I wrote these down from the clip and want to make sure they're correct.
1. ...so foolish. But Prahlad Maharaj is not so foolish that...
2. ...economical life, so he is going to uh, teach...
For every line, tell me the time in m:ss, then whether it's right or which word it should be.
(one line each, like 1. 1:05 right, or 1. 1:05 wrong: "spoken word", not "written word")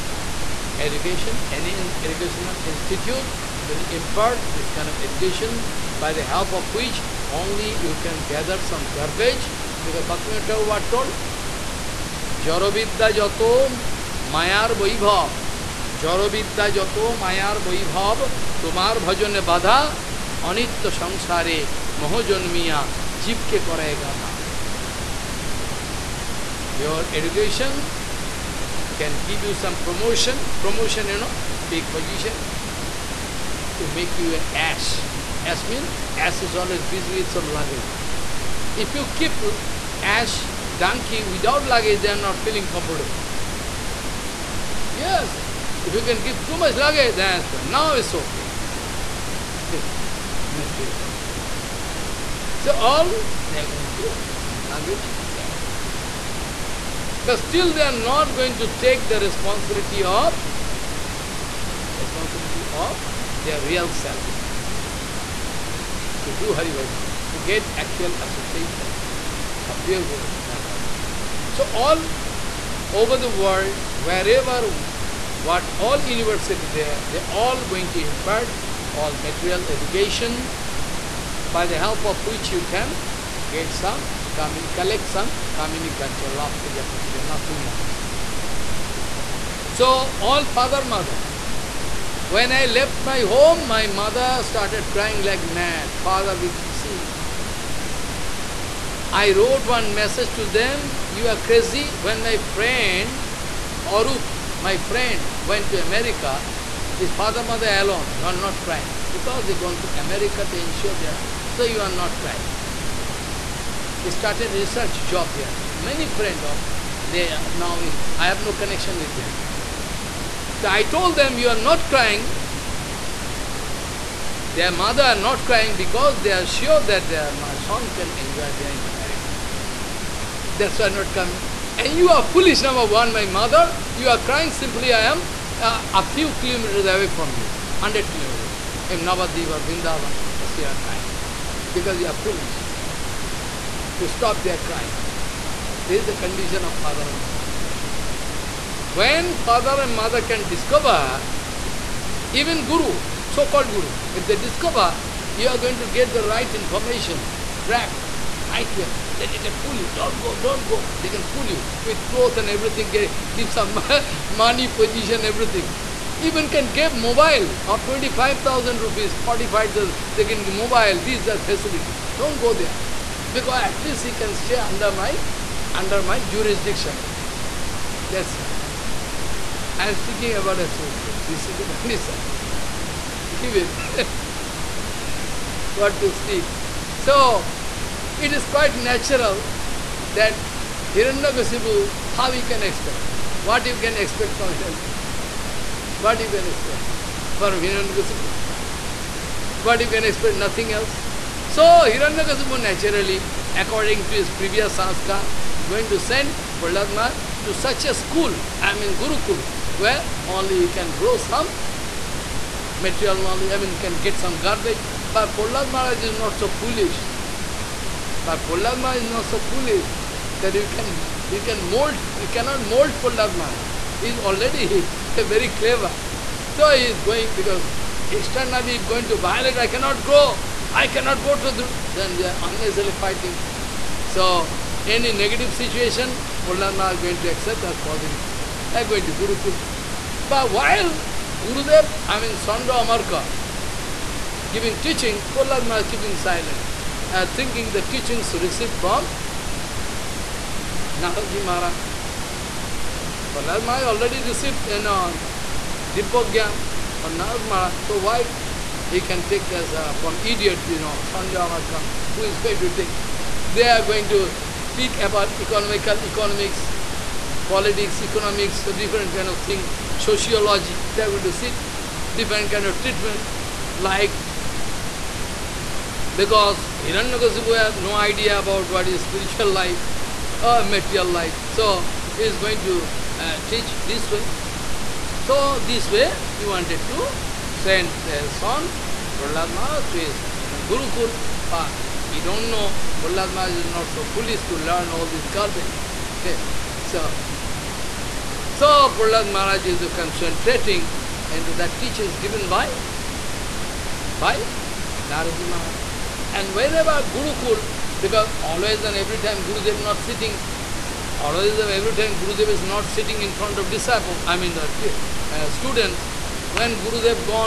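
1. 3:36 right
2. 4:40 wrong: "material", not "economical".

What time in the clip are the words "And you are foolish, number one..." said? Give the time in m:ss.
2:11.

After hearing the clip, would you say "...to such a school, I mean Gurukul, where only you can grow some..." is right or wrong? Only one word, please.
right.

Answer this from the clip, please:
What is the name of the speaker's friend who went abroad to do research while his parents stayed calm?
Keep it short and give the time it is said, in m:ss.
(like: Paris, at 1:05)
Arup, at 1:43.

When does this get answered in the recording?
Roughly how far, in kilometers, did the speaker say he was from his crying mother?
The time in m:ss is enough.
2:17.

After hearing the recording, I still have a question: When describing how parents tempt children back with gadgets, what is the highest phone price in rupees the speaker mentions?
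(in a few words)
45,000.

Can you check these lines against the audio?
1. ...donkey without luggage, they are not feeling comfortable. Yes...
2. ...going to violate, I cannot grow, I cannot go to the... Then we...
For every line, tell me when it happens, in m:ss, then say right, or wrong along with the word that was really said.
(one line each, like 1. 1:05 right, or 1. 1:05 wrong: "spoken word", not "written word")
1. 0:40 right
2. 3:48 right.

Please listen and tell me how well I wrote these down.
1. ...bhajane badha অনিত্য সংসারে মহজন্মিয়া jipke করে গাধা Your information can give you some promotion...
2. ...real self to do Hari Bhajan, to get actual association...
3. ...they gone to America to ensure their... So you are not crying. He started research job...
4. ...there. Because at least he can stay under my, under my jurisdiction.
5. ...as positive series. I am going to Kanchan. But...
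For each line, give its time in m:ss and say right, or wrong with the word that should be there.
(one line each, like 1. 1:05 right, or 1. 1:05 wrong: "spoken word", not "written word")
1. 0:18 wrong: "education", not "information"
2. 1:03 right
3. 1:49 right
4. 2:52 right
5. 3:57 wrong: "Gurukul", not "Kanchan".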